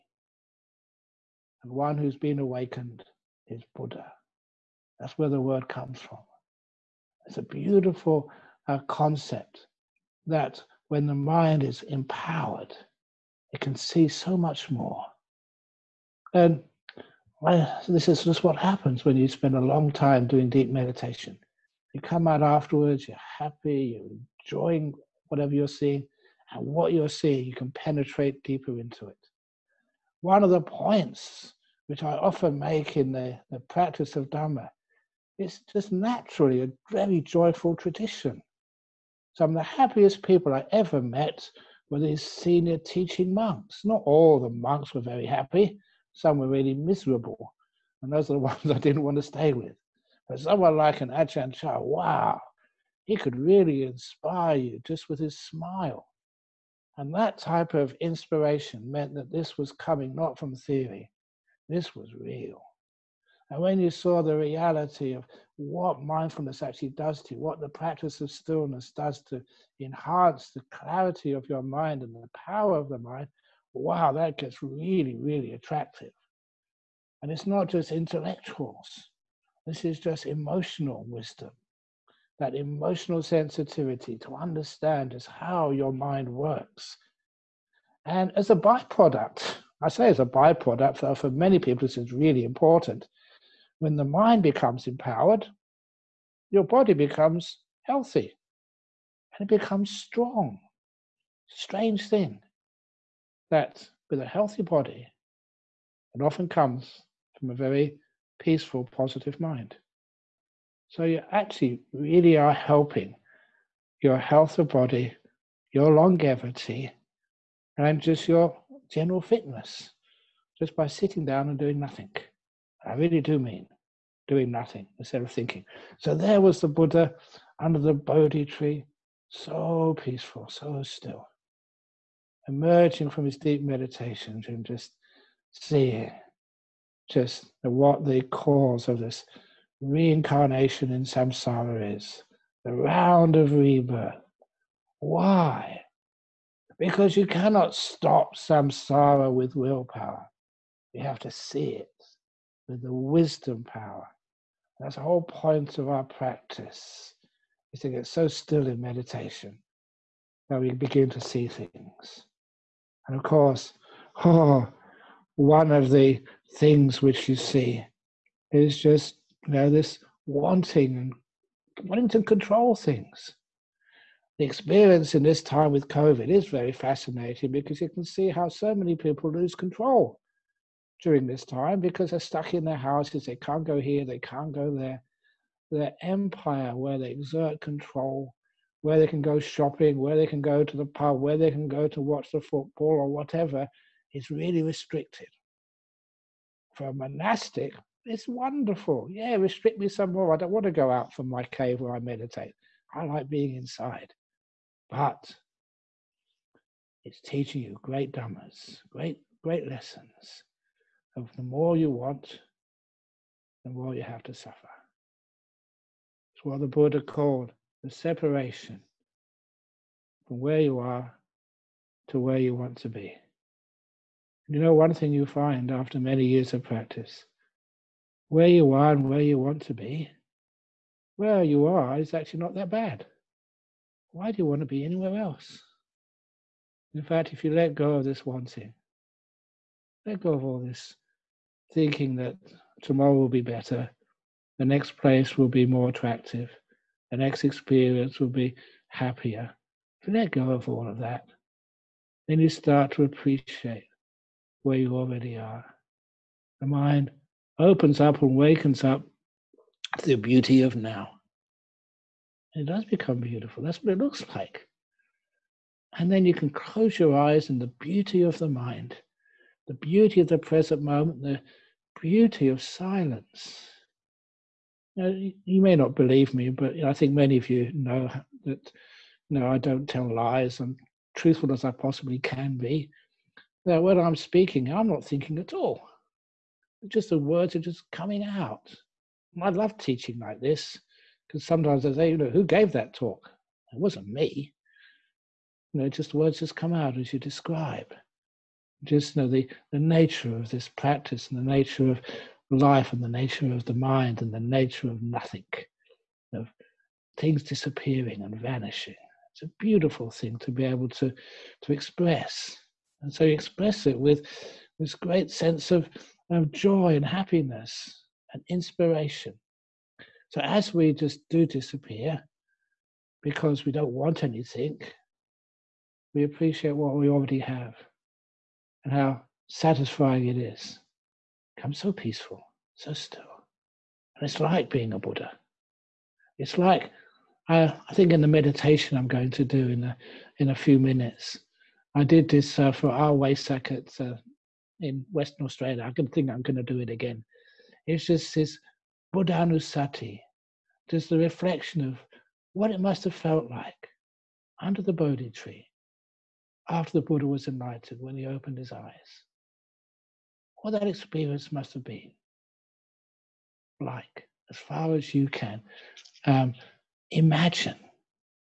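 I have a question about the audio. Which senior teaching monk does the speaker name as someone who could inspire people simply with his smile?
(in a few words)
Ajahn Chah.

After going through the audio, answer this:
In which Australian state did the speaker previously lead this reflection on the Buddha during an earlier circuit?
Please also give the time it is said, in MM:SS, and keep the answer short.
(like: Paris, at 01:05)
Western Australia, at 05:45.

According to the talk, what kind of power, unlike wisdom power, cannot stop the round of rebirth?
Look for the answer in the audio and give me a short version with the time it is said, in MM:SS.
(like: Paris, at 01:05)
willpower, at 02:29.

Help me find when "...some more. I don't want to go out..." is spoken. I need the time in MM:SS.
03:19.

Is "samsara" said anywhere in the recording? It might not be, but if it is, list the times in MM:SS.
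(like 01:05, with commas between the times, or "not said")
02:21, 02:28.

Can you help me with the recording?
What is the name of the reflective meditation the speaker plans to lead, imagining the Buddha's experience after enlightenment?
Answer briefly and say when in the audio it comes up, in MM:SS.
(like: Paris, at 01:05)
Buddhanusati, at 05:49.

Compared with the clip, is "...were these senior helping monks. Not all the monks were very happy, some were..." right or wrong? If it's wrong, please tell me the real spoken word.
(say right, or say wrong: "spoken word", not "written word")
wrong: "teaching", not "helping".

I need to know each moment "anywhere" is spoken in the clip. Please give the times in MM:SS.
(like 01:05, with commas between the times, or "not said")
03:54.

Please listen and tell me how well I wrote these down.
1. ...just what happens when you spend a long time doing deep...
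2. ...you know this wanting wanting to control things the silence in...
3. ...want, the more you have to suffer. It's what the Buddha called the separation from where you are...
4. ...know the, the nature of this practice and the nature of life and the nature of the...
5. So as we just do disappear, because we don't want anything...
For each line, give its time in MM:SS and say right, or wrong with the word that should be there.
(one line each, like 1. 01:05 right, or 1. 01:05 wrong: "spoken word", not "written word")
1. 00:18 right
2. 02:49 wrong: "experience", not "silence"
3. 03:31 right
4. 04:59 right
5. 05:20 right.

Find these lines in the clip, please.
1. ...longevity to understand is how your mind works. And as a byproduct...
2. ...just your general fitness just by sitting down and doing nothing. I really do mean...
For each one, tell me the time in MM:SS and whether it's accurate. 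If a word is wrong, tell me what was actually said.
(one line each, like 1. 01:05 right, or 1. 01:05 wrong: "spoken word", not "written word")
1. 01:23 wrong: "sensitivity", not "longevity"
2. 01:57 right.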